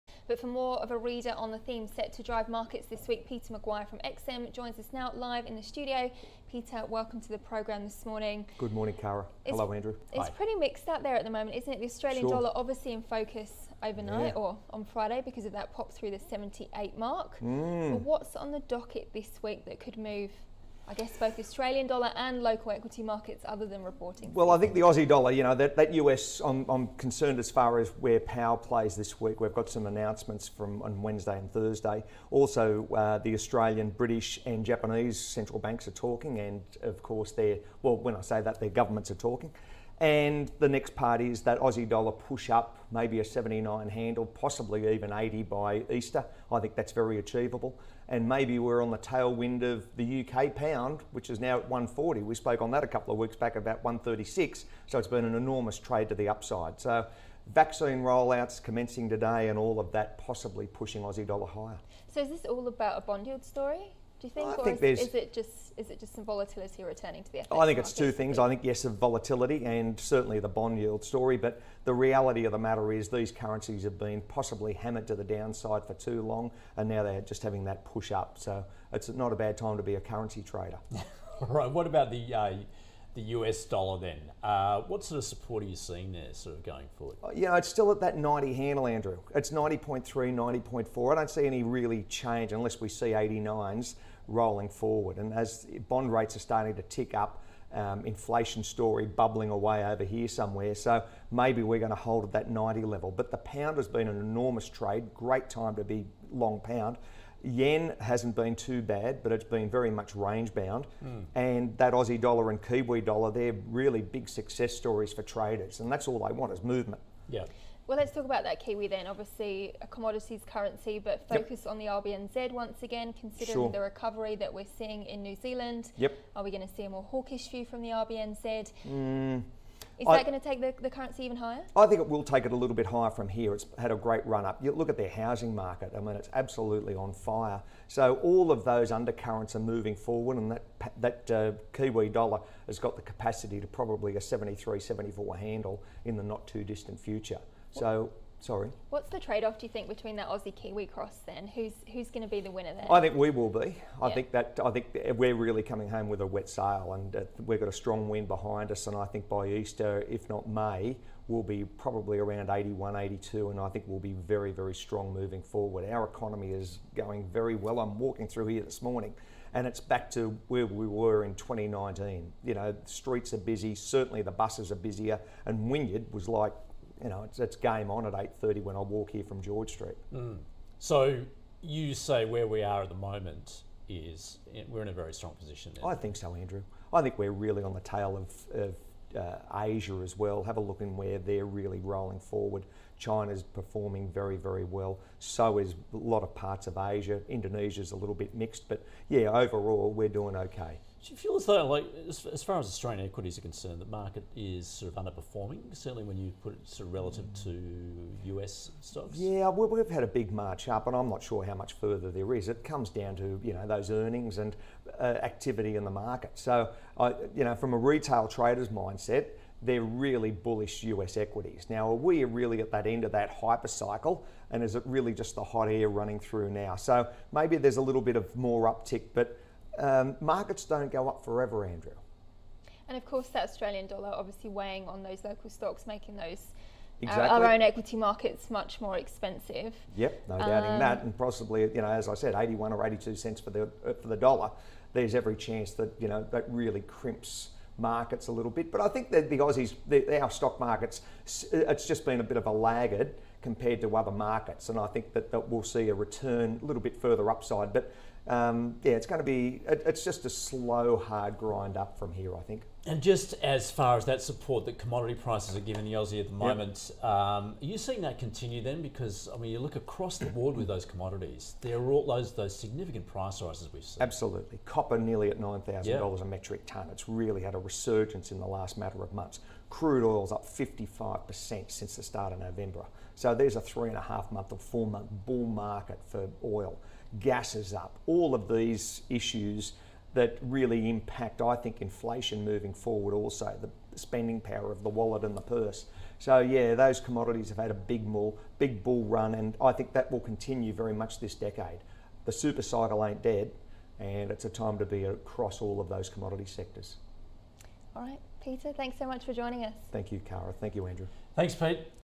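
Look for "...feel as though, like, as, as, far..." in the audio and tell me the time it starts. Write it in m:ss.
3:21.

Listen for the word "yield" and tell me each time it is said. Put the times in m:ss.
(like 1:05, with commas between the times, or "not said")
1:03, 1:10.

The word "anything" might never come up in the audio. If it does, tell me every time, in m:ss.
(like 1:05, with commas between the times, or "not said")
not said.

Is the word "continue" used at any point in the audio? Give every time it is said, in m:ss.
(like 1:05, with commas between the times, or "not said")
4:28, 5:00.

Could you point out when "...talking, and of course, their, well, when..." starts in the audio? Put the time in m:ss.
0:35.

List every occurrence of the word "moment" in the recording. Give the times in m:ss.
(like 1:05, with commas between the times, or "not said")
0:11, 3:02, 4:26.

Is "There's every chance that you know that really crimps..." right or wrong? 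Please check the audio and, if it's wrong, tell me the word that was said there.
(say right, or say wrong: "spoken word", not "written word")
right.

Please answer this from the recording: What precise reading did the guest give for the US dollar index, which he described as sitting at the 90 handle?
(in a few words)
90.3.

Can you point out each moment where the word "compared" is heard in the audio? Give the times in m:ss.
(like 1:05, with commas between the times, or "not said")
4:13.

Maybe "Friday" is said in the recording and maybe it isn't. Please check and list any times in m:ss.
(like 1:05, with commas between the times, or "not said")
0:14.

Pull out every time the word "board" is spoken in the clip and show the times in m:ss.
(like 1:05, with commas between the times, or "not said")
4:30.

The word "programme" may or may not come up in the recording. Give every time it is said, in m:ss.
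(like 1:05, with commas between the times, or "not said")
0:07.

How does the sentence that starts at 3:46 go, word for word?
So maybe there's a little bit of more uptick, but um, markets don't go up forever, Andrew.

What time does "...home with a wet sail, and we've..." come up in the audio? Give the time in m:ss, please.
2:35.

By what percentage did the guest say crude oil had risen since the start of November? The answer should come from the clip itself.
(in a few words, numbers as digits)
55%.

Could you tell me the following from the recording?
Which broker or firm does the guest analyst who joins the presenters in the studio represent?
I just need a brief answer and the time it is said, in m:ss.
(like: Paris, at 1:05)
XM, at 0:03.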